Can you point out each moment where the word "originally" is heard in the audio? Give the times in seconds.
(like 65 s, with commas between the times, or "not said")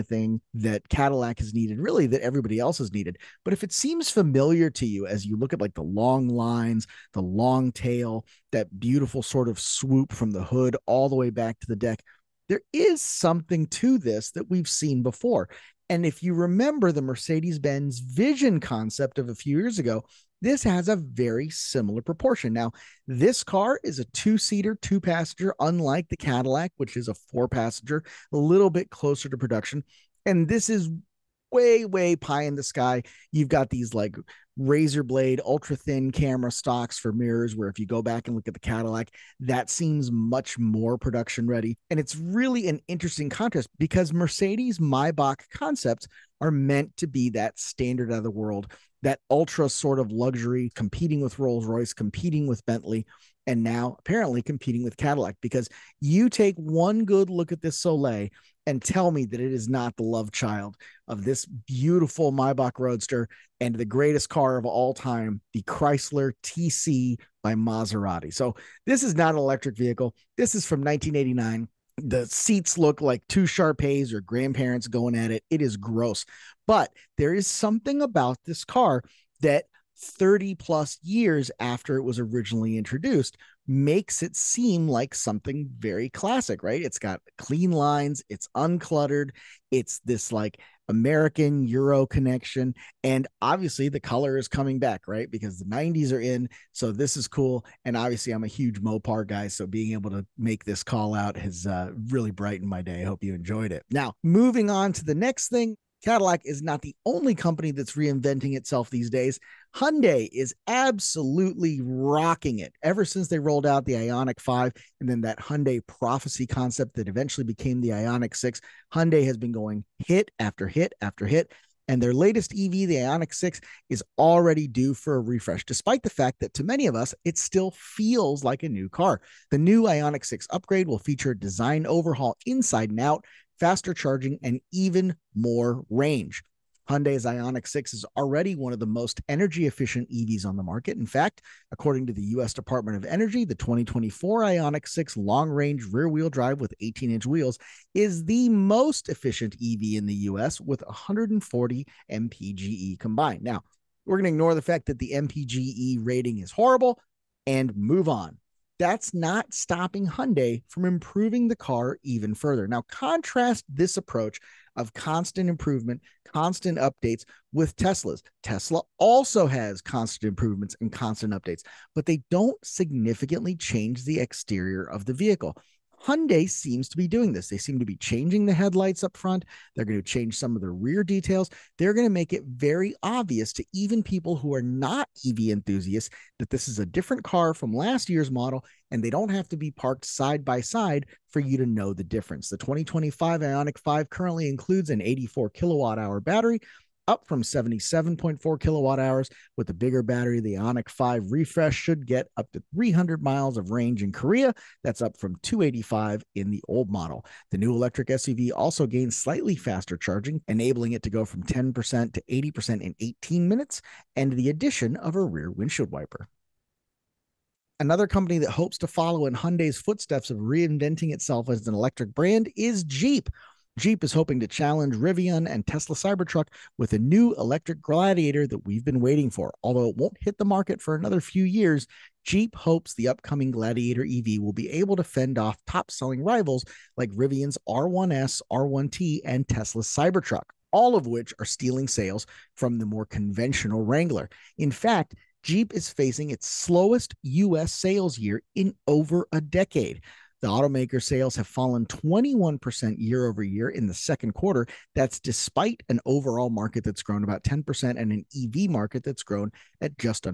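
82 s.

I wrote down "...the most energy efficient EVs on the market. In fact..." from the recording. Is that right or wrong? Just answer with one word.
right.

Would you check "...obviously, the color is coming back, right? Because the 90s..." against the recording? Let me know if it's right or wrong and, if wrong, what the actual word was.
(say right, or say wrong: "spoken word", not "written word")
right.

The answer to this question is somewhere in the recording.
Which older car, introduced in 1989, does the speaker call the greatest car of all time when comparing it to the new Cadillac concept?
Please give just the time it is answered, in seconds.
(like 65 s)
65 s.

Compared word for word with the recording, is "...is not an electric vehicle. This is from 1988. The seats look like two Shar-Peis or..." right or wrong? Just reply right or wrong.
wrong.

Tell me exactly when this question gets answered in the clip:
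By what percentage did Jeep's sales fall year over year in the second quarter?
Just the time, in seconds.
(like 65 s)
251 s.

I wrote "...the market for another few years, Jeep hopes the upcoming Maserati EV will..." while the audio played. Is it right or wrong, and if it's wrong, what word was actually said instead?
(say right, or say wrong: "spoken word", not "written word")
wrong: "Gladiator", not "Maserati".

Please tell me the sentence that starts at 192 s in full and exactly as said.
The 2025 IONIQ 5 currently includes an 84 kilowatt hour battery up from 77.4 kilowatt hours with the bigger battery.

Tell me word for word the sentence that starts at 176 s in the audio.
Hyundai seems to be doing this.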